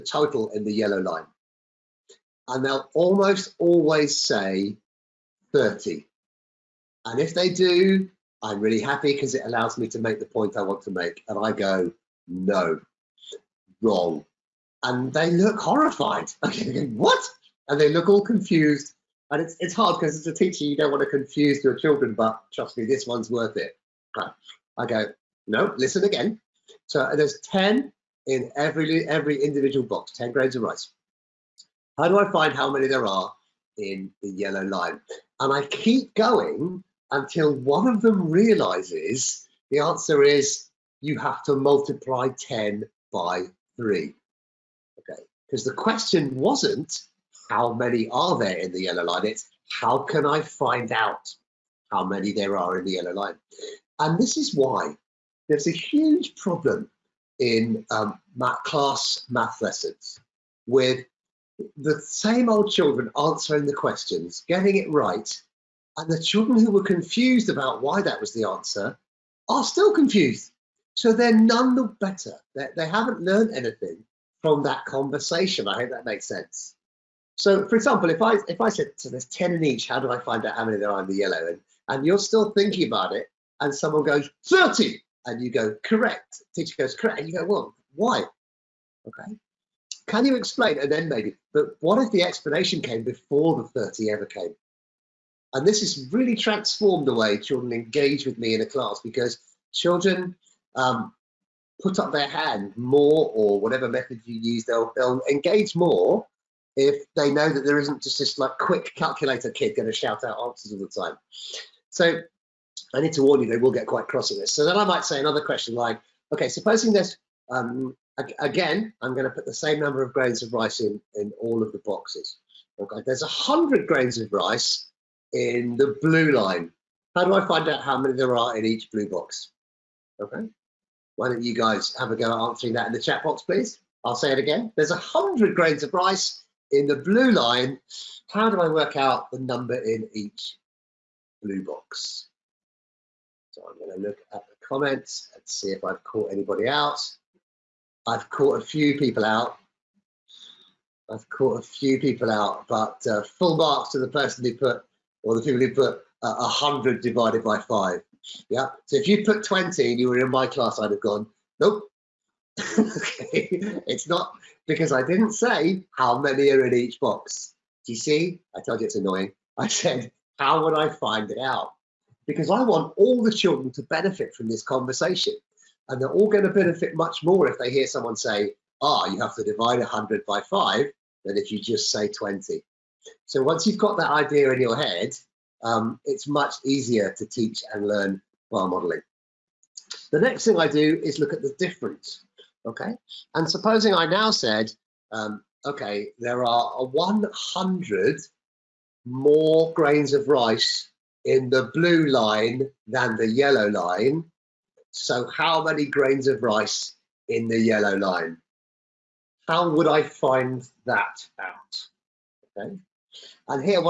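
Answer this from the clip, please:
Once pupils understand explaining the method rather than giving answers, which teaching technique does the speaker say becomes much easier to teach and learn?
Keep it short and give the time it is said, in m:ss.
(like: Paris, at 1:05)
bar modeling, at 3:08.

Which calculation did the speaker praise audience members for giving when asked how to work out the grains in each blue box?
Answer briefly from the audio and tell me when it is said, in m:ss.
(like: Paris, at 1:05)
100 divided by 5, at 2:36.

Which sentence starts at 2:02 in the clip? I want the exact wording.
Okay, there's 100 grains of rice in the blue line.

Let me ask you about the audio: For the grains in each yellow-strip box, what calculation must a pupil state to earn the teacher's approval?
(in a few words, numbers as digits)
multiply 10 by 3.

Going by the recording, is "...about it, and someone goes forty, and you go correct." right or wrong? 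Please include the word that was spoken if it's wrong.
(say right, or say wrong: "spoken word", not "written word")
wrong: "thirty", not "forty".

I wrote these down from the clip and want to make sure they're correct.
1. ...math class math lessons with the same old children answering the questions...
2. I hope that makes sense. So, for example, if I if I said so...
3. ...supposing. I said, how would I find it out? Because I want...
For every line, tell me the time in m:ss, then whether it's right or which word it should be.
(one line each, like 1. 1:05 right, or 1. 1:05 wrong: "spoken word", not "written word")
1. 0:58 right
2. 1:15 right
3. 2:48 wrong: "annoying", not "supposing".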